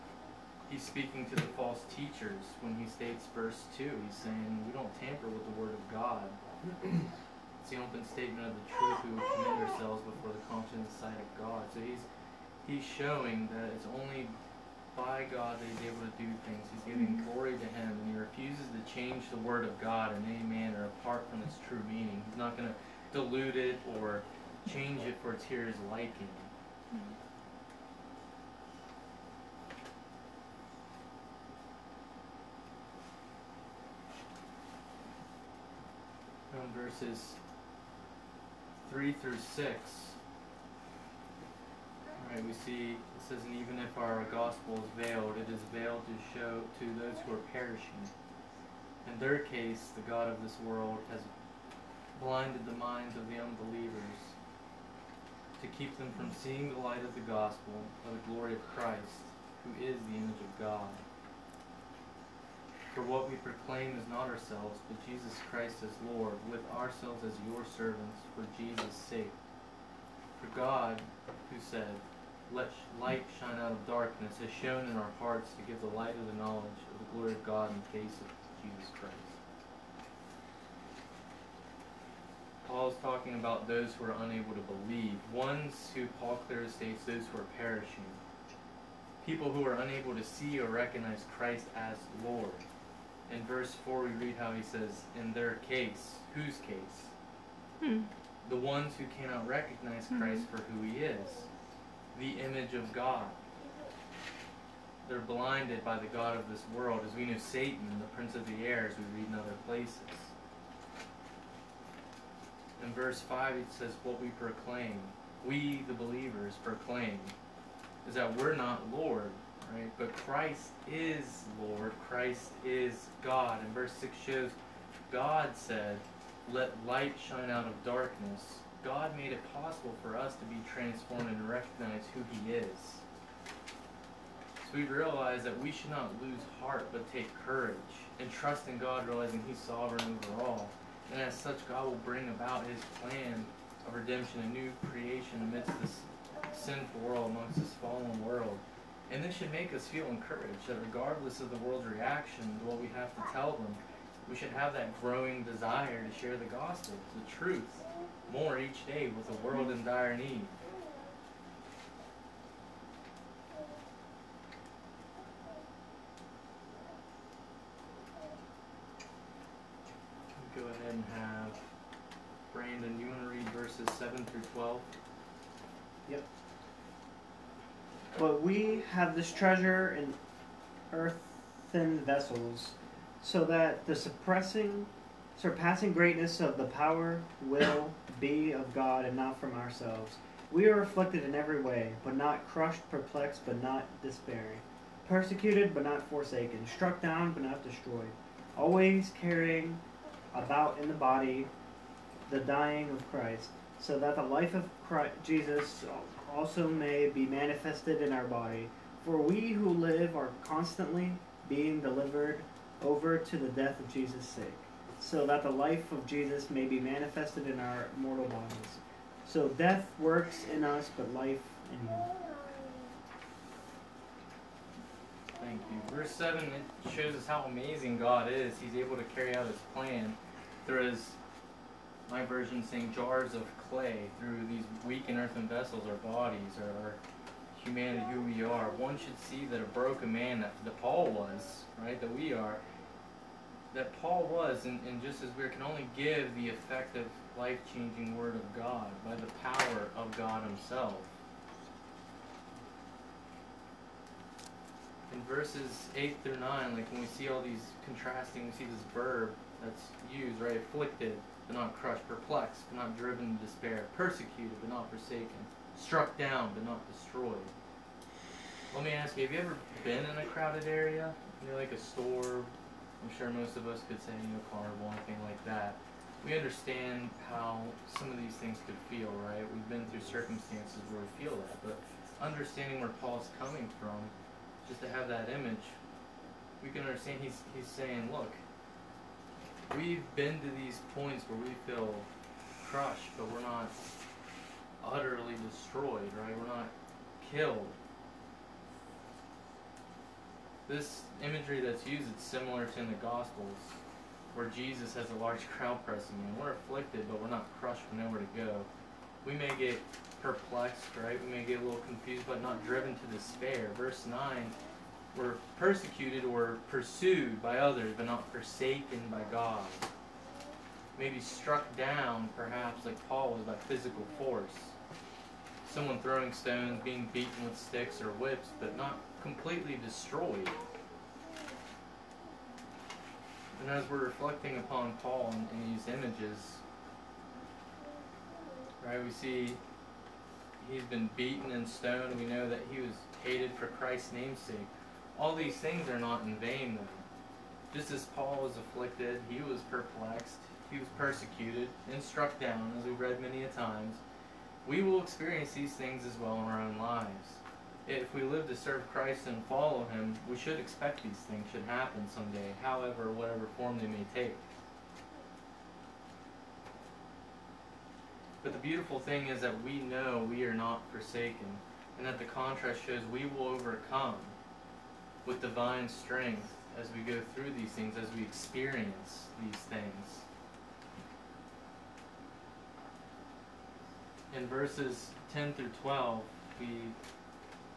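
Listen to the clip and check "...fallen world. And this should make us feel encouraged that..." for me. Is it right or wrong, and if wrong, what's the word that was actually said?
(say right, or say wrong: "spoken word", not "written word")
right.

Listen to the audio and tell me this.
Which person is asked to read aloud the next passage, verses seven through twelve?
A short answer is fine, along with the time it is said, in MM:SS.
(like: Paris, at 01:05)
Brandon, at 02:52.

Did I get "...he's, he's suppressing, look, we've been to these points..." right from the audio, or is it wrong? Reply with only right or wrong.
wrong.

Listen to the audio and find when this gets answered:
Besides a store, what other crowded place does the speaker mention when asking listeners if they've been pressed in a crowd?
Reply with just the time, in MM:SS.
04:34.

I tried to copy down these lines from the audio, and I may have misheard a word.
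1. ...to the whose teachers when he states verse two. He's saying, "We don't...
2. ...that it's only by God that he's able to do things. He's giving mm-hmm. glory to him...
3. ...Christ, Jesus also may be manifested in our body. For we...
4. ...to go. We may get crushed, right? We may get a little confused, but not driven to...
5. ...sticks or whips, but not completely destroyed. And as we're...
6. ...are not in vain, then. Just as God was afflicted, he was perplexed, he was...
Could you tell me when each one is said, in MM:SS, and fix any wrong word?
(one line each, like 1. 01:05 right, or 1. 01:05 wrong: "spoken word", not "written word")
1. 00:01 wrong: "false", not "whose"
2. 00:13 right
3. 03:24 right
4. 05:08 wrong: "perplexed", not "crushed"
5. 05:27 right
6. 05:45 wrong: "Paul", not "God".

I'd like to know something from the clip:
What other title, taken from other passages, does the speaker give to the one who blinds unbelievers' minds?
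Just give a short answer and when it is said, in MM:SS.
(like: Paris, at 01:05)
prince of the air, at 01:47.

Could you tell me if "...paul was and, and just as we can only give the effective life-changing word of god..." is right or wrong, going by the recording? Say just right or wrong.
right.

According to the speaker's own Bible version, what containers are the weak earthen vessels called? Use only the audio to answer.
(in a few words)
jars of clay.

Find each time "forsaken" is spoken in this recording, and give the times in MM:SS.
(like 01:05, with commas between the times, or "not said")
03:16, 04:24, 05:18, 06:10.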